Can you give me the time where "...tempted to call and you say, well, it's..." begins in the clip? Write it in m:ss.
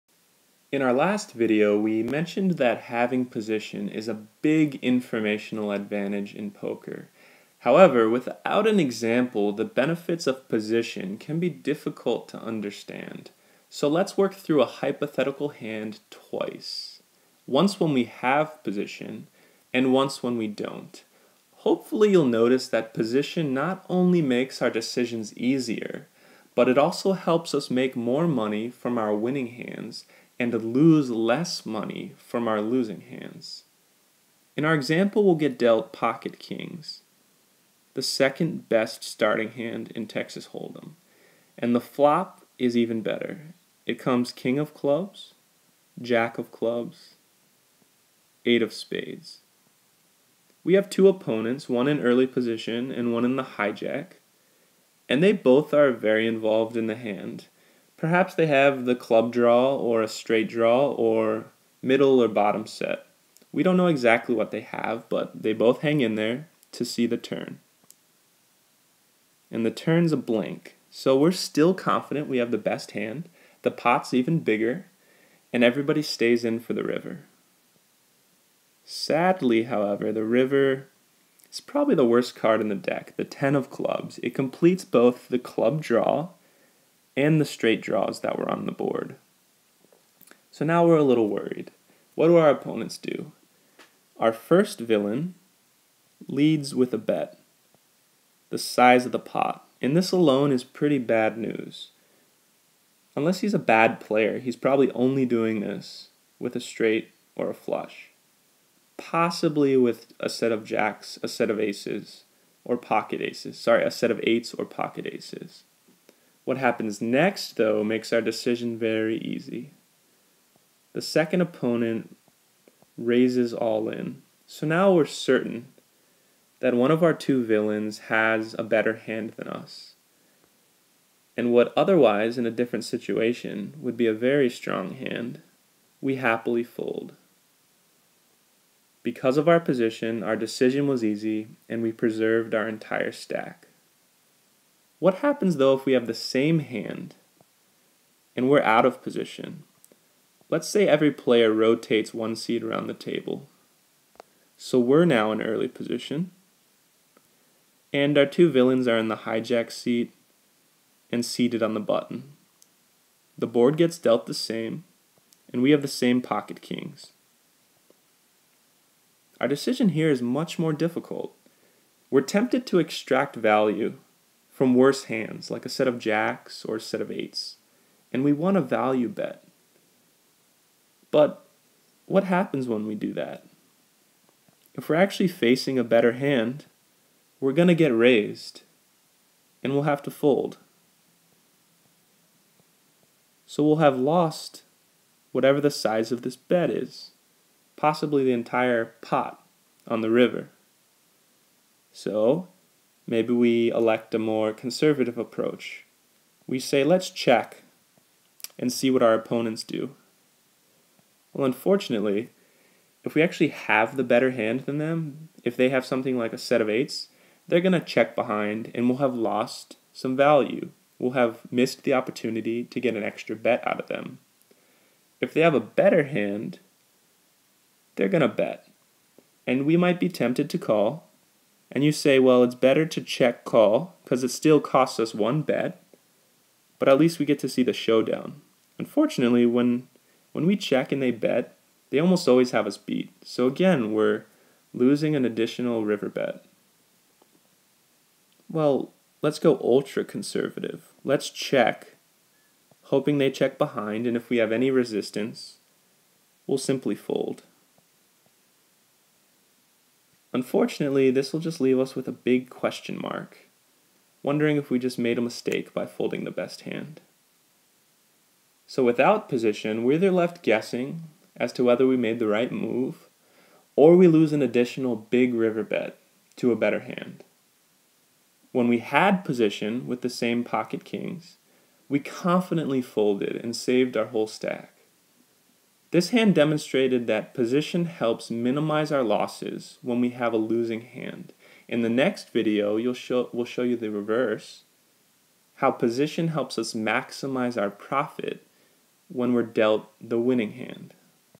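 3:50.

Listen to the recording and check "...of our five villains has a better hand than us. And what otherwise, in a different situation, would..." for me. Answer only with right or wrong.
wrong.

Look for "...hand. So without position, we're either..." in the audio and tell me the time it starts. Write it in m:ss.
4:26.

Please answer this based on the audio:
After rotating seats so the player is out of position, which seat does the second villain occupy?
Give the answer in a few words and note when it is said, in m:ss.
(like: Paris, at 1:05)
The button, at 2:41.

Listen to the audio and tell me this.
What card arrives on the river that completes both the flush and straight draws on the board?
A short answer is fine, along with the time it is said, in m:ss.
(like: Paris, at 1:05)
10 of clubs, at 1:23.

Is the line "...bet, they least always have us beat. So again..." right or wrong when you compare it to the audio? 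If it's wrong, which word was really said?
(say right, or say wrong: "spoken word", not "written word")
wrong: "almost", not "least".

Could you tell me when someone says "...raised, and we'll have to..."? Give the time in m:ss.
3:07.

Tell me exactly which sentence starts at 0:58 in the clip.
Perhaps they have the club draw or a straight draw or middle or bottom set.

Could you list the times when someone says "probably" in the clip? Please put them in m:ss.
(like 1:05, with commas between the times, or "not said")
1:21, 1:44.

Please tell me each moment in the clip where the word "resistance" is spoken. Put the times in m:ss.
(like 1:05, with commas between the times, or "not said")
4:14.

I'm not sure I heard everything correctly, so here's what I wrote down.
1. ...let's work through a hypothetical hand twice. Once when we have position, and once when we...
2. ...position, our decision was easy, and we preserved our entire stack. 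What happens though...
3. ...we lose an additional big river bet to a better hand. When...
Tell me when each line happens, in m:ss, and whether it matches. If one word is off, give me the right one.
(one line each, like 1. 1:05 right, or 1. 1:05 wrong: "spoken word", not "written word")
1. 0:13 right
2. 2:19 right
3. 4:33 right.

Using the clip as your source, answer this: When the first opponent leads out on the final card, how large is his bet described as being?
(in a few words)
The size of the pot.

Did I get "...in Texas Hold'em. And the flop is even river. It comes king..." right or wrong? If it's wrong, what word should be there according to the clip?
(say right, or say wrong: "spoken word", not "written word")
wrong: "better", not "river".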